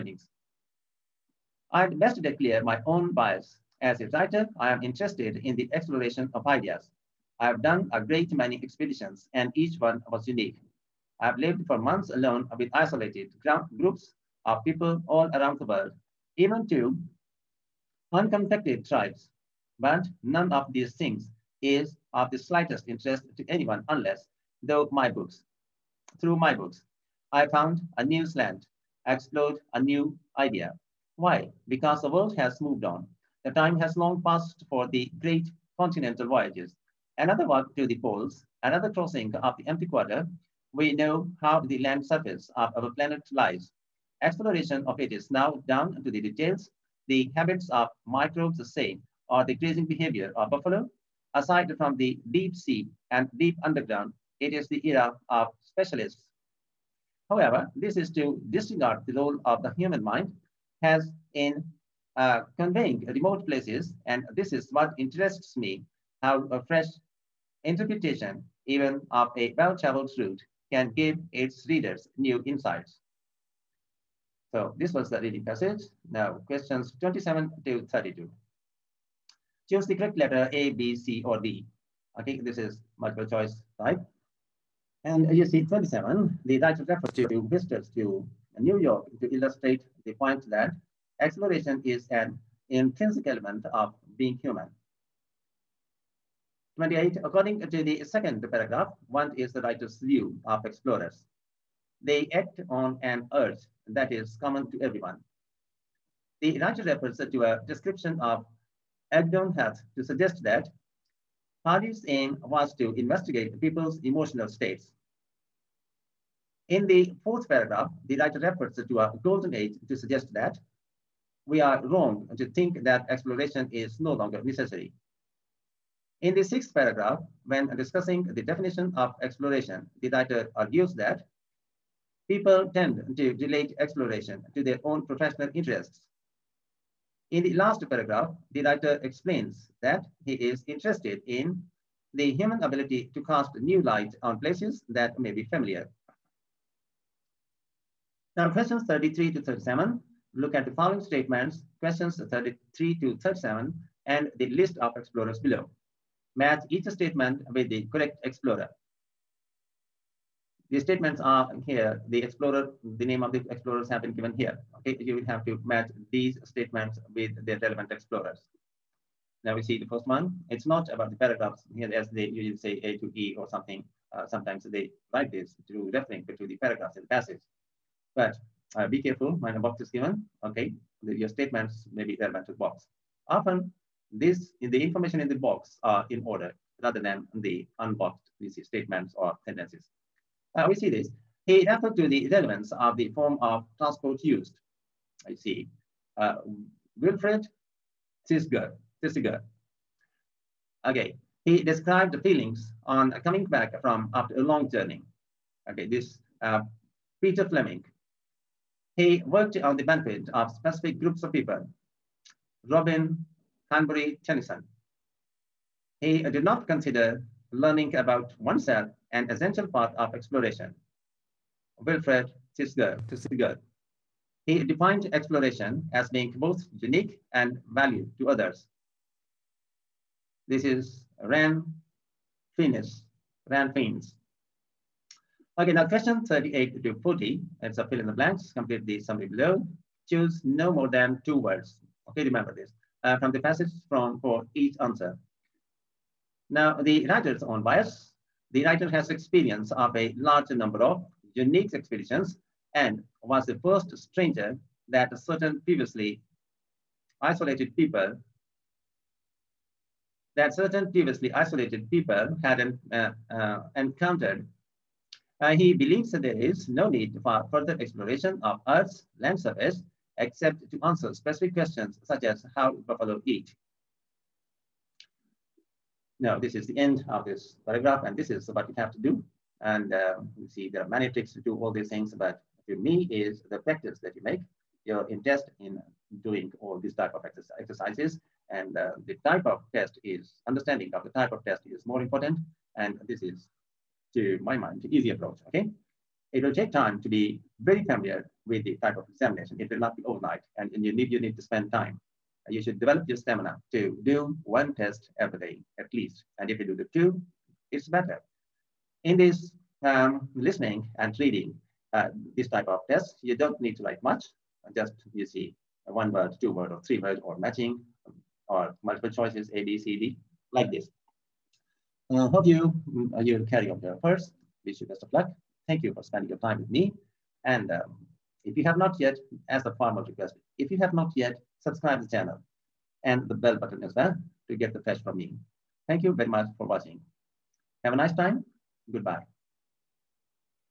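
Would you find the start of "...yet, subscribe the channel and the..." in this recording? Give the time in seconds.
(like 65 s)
331 s.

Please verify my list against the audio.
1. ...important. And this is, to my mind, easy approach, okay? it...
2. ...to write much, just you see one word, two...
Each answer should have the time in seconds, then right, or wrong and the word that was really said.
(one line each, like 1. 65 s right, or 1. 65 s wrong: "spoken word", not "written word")
1. 292 s right
2. 313 s right.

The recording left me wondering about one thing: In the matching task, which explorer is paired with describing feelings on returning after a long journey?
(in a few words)
Peter Fleming.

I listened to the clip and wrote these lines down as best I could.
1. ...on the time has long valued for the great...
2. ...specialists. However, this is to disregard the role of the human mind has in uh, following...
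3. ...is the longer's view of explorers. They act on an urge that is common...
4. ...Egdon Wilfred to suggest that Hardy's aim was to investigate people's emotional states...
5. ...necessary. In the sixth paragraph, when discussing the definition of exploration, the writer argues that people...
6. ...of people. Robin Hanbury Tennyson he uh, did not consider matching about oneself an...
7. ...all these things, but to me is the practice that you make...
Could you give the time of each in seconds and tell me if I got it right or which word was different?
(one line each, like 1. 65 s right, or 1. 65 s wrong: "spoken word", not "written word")
1. 32 s wrong: "passed", not "valued"
2. 55 s wrong: "conveying", not "following"
3. 99 s wrong: "writer", not "longer"
4. 109 s wrong: "Heath", not "Wilfred"
5. 124 s right
6. 211 s wrong: "learning", not "matching"
7. 281 s right.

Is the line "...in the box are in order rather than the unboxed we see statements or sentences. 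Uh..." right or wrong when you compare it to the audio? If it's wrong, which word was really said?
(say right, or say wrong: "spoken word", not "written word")
right.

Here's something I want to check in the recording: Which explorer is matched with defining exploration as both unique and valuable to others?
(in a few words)
Ran Fiennes.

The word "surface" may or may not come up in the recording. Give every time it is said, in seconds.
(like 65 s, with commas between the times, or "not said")
42 s, 269 s.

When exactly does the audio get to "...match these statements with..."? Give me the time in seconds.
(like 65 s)
165 s.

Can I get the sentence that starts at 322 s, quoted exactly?
Uh, hope you mm, uh, you carry on your first.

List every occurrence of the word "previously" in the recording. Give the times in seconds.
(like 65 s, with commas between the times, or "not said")
255 s, 260 s.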